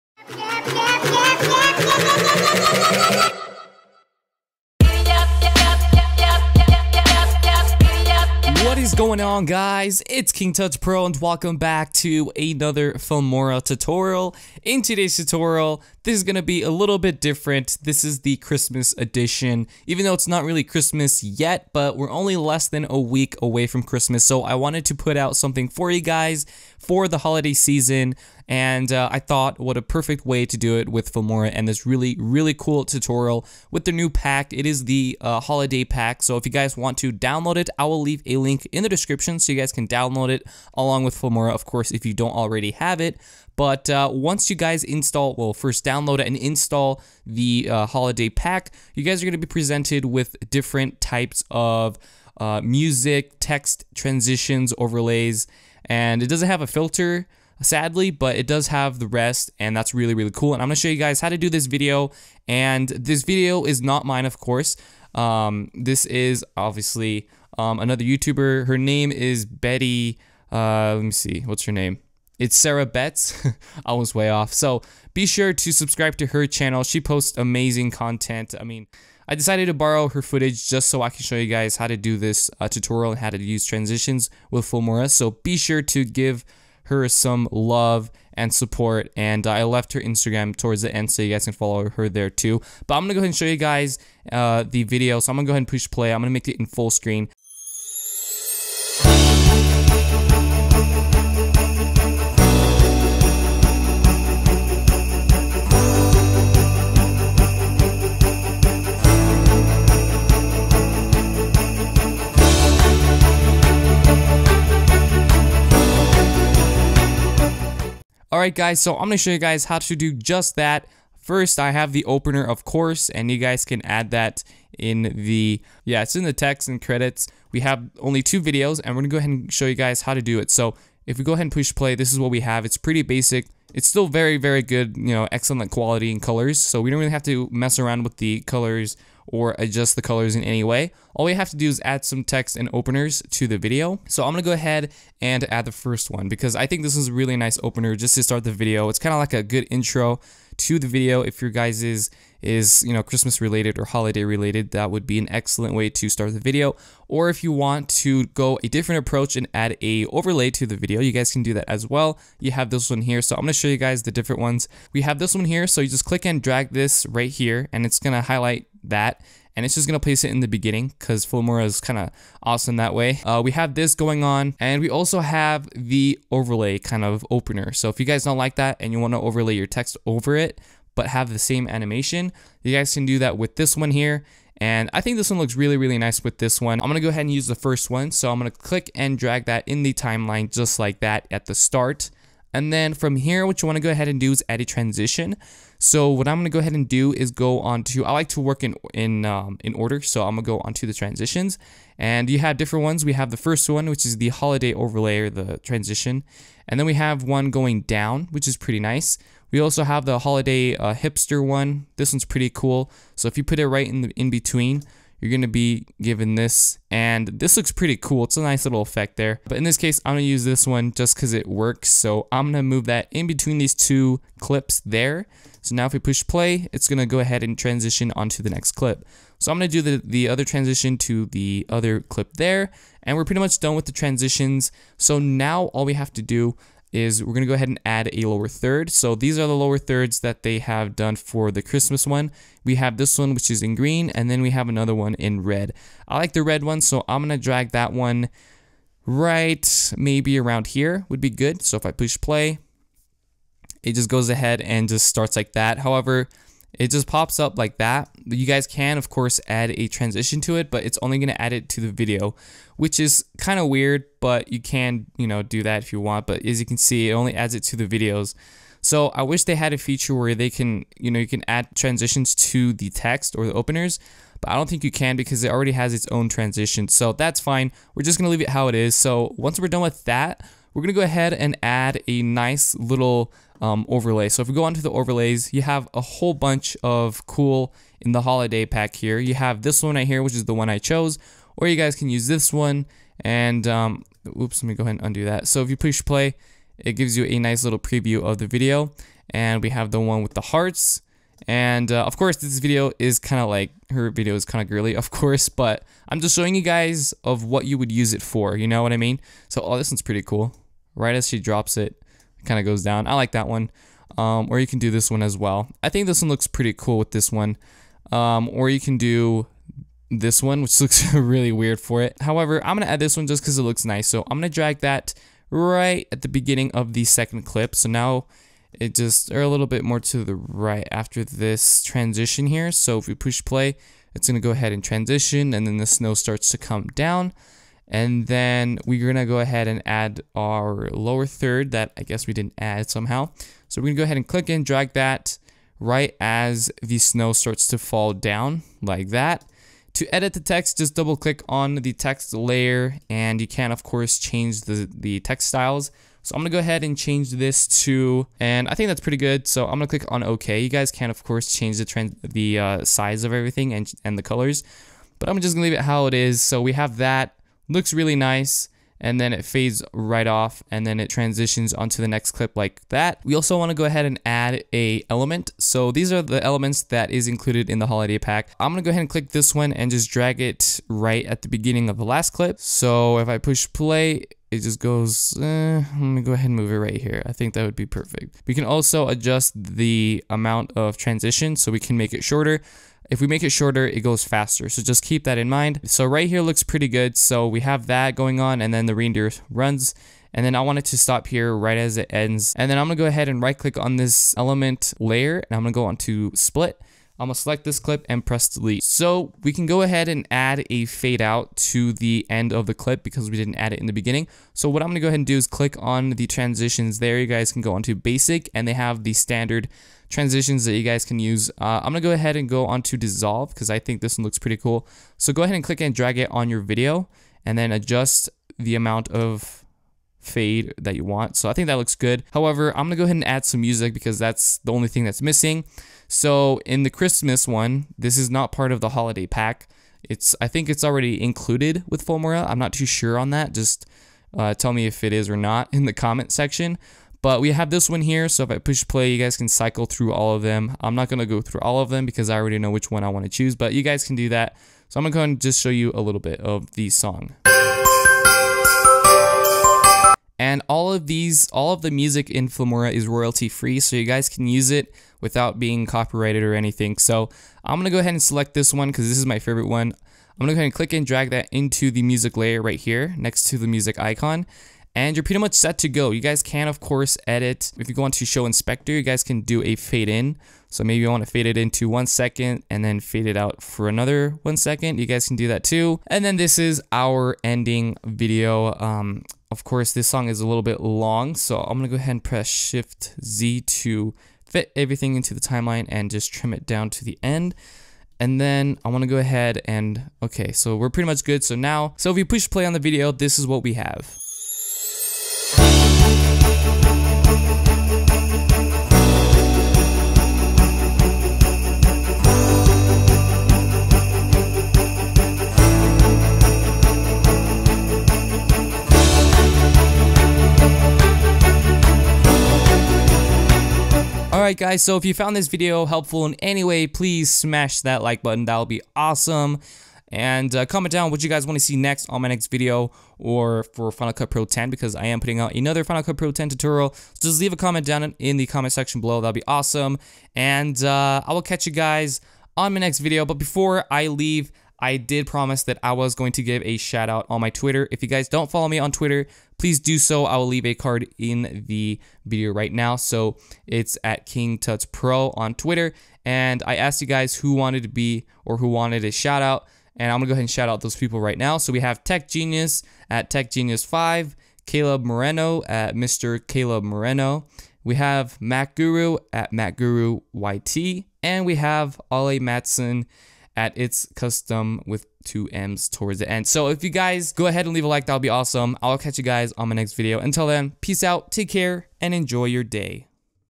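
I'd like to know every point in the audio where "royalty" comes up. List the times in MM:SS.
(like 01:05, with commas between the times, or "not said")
07:43.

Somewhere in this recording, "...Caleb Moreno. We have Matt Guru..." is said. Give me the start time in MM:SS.
09:26.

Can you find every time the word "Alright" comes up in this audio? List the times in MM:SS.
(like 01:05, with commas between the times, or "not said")
01:58, 08:44.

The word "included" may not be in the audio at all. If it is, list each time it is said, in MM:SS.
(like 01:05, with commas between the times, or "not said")
06:17, 07:21.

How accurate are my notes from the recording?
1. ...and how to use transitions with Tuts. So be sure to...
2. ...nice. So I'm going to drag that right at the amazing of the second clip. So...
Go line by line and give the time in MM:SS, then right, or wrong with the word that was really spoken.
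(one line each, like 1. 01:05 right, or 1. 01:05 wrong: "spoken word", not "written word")
1. 01:23 wrong: "Filmora", not "Tuts"
2. 05:23 wrong: "beginning", not "amazing".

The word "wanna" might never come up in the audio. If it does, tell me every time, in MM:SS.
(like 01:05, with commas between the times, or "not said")
02:58, 08:18.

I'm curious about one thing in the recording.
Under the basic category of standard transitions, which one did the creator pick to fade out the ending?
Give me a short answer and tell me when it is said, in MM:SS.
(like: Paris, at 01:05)
dissolve, at 07:02.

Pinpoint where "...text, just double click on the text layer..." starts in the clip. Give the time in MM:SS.
05:50.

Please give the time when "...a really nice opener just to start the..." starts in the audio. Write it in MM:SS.
02:27.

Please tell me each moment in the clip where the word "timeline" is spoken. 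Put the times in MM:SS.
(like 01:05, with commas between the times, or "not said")
03:09, 08:15.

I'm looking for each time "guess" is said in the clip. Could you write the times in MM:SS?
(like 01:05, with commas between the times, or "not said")
05:42.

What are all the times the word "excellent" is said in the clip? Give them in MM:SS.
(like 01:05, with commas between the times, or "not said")
02:15, 02:35.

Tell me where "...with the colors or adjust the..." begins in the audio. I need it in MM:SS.
02:18.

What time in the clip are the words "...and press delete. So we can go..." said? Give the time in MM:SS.
06:48.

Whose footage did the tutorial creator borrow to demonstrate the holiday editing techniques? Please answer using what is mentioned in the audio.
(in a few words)
Sarah Betts.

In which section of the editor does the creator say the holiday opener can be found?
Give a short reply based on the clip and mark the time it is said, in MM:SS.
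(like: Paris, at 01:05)
text and credits, at 02:06.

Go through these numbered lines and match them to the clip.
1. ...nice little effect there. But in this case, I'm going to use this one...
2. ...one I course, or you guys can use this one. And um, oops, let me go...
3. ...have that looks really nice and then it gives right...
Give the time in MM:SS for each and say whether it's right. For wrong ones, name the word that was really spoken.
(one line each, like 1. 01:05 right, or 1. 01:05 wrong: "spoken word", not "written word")
1. 03:38 right
2. 04:50 wrong: "chose", not "course"
3. 06:06 wrong: "fades", not "gives".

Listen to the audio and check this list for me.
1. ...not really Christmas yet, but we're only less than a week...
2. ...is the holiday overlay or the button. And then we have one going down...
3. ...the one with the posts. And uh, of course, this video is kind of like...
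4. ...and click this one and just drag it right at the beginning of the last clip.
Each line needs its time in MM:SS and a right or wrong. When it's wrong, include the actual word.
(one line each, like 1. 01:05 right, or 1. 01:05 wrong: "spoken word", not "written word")
1. 00:20 right
2. 03:24 wrong: "transition", not "button"
3. 04:59 wrong: "hearts", not "posts"
4. 06:19 right.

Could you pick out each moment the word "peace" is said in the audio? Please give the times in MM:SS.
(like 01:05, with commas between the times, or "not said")
09:40.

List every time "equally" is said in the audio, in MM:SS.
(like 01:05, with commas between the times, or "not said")
not said.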